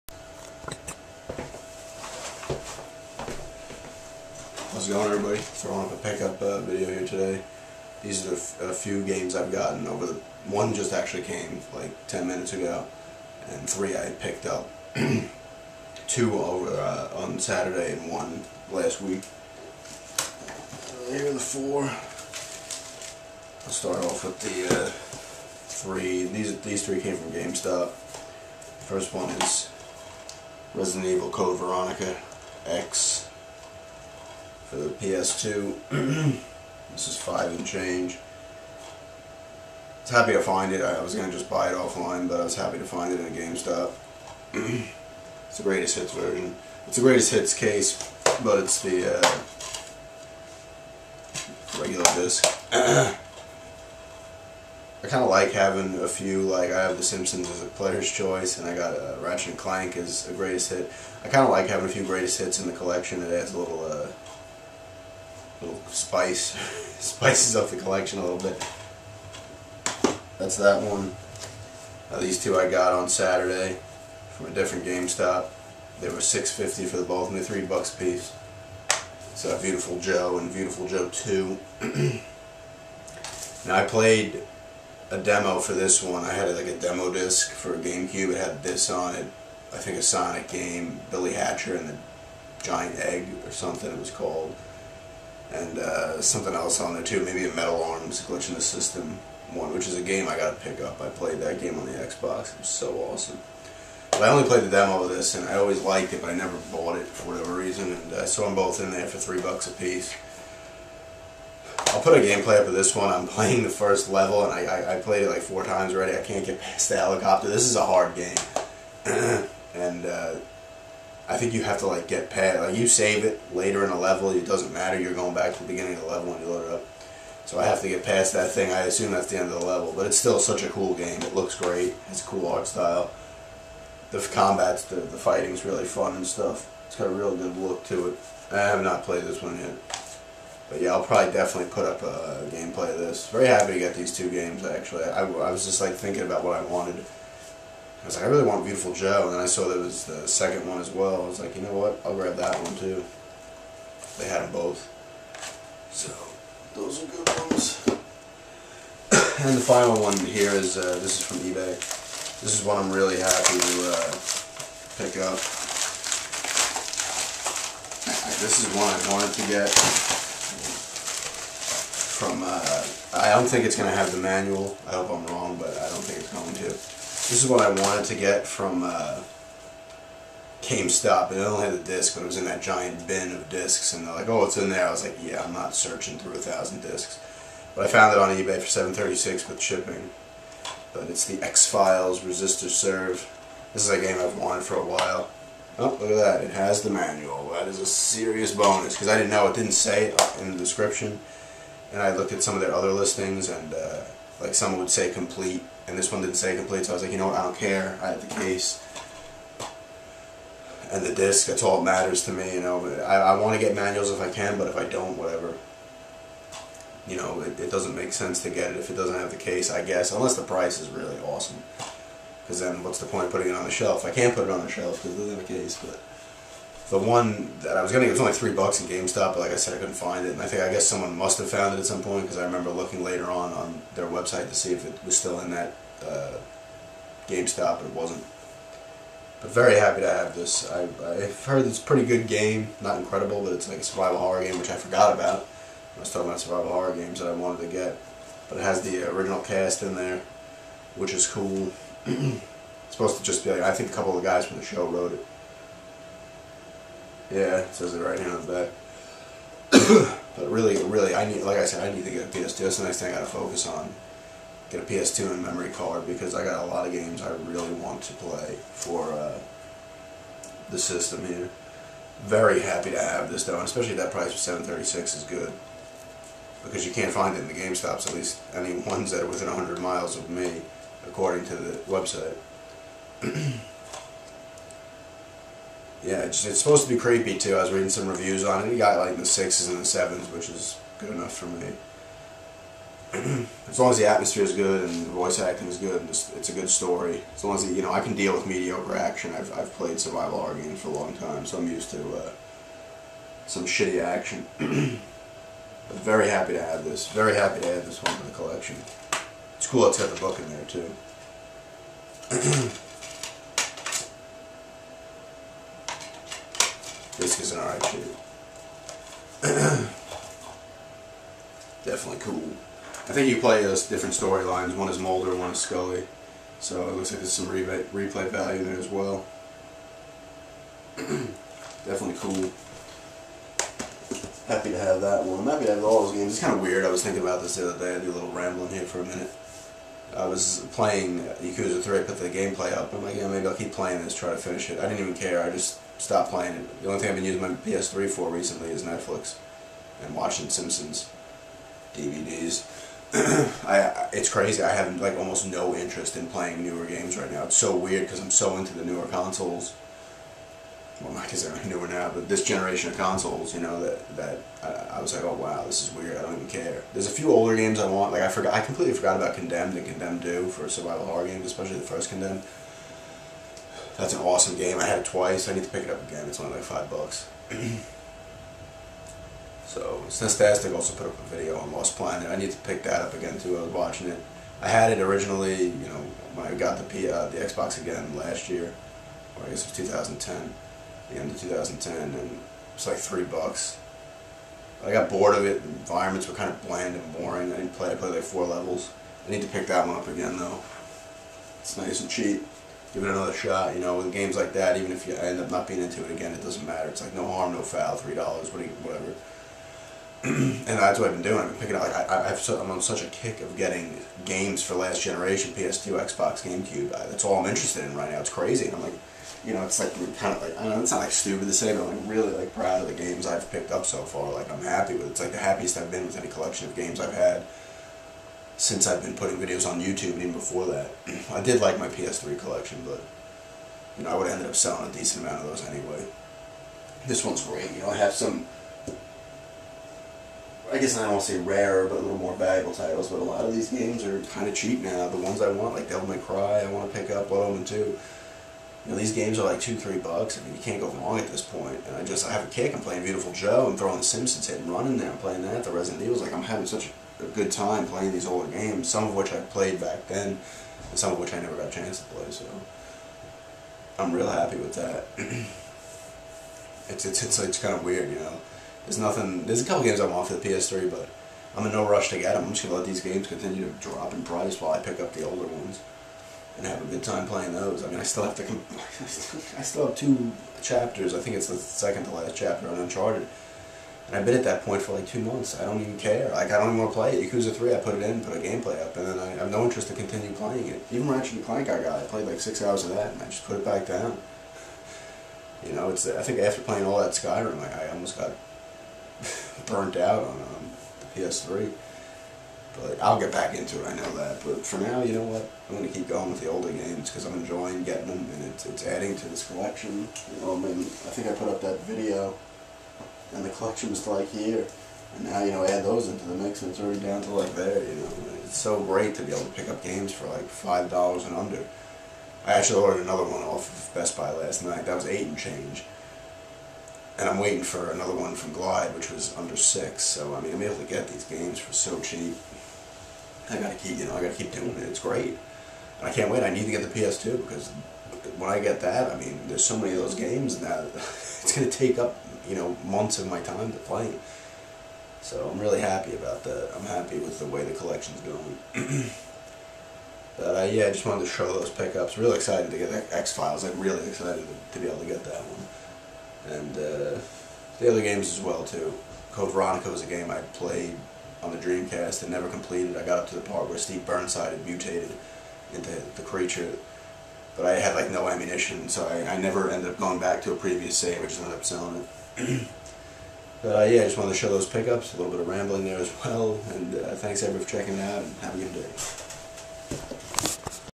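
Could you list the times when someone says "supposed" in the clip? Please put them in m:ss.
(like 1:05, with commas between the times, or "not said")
4:12, 4:46.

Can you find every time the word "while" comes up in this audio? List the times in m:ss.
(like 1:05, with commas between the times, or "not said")
3:14, 7:54.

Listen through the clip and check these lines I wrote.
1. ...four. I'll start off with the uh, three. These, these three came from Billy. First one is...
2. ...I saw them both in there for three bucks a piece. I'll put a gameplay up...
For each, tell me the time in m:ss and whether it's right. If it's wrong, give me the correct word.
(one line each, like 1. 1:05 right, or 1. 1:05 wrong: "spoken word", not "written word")
1. 0:21 wrong: "GameStop", not "Billy"
2. 1:48 right.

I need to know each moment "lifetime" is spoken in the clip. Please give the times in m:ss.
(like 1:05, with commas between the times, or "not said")
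not said.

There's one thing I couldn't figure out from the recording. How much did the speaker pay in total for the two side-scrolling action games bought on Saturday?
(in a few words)
6.50.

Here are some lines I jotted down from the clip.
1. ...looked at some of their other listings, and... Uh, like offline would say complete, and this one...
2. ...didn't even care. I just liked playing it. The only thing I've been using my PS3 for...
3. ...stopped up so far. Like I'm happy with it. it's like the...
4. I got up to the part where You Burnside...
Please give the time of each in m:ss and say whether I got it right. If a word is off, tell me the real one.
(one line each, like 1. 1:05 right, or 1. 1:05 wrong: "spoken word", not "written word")
1. 3:22 wrong: "someone", not "offline"
2. 5:44 wrong: "stopped", not "liked"
3. 7:03 wrong: "picked", not "stopped"
4. 9:22 wrong: "Steve", not "You".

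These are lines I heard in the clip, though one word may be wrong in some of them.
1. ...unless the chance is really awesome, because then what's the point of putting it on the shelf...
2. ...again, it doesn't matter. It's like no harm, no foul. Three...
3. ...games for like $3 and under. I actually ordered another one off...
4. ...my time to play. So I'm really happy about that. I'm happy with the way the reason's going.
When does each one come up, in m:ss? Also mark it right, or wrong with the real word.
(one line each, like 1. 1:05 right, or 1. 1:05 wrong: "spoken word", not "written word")
1. 3:40 wrong: "price", not "chance"
2. 6:46 right
3. 8:39 wrong: "5", not "3"
4. 9:03 wrong: "collection", not "reason".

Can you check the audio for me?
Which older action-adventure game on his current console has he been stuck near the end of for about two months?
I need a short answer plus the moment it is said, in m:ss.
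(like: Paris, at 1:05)
Uncharted, at 8:02.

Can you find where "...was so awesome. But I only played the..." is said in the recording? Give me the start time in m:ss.
1:42.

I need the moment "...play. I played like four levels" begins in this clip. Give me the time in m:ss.
6:37.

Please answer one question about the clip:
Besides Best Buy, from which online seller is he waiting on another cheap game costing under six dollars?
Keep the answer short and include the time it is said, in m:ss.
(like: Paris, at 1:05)
Glyde, at 8:48.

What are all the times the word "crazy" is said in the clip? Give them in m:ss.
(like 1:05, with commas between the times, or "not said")
5:54, 6:58.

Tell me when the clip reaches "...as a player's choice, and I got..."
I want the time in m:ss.
0:57.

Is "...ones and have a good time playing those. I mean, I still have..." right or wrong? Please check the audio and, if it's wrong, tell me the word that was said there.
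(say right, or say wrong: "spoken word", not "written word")
right.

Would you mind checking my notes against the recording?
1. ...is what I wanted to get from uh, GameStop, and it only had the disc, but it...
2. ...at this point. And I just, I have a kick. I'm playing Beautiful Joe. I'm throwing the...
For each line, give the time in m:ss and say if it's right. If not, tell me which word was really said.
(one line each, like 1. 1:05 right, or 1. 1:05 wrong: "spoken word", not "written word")
1. 2:57 right
2. 7:31 right.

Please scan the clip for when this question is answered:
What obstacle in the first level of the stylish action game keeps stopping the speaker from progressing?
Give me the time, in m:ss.
1:56.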